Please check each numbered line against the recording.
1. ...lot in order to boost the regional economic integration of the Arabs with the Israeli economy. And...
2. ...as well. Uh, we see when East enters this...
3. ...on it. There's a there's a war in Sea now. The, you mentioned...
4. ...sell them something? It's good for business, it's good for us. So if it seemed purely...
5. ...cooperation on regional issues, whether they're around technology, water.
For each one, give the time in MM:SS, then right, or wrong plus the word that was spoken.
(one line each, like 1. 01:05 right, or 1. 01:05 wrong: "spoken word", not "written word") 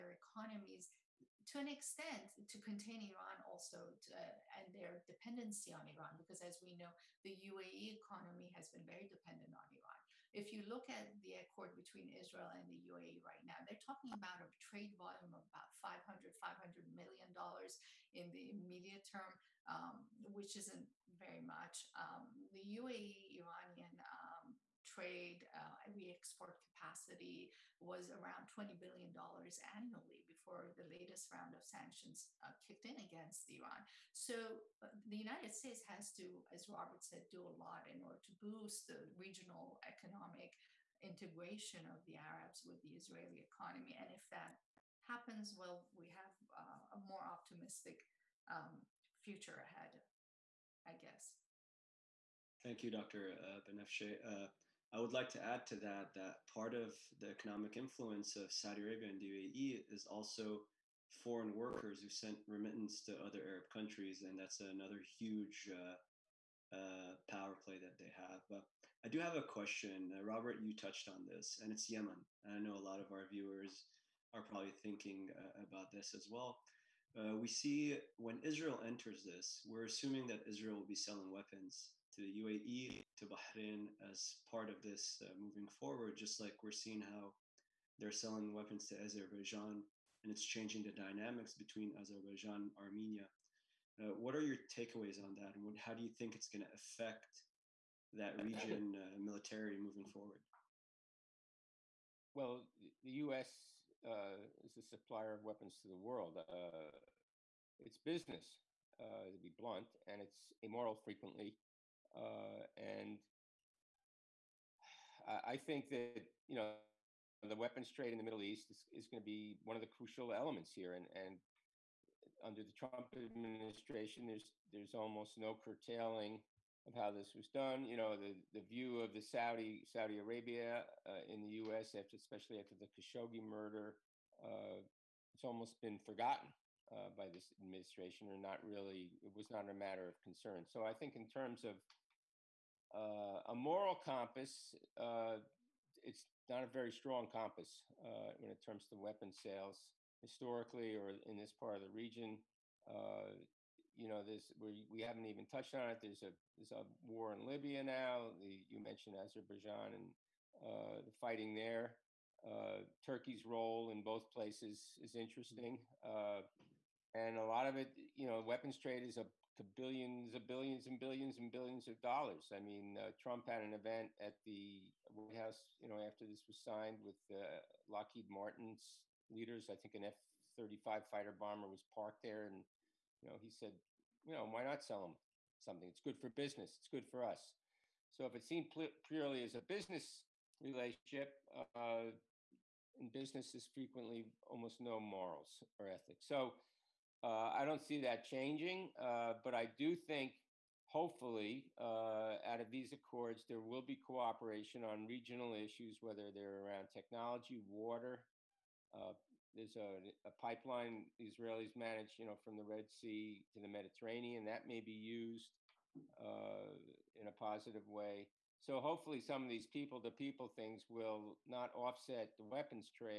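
1. 00:37 right
2. 01:16 wrong: "Israel", not "East"
3. 02:35 wrong: "Libya", not "Sea"
4. 03:04 right
5. 03:23 right.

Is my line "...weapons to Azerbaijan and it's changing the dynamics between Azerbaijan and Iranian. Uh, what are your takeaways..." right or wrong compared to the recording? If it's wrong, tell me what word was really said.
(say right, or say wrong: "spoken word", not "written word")
wrong: "Armenia", not "Iranian".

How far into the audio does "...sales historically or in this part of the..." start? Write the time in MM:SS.
02:29.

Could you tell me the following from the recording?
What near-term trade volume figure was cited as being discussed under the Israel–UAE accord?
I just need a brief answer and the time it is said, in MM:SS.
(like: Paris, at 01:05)
$500 million, at 00:16.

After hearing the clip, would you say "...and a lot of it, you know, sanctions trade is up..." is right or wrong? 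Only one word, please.
wrong.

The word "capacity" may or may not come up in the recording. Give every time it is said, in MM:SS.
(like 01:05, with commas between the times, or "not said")
00:26.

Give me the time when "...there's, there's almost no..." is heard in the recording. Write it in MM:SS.
02:04.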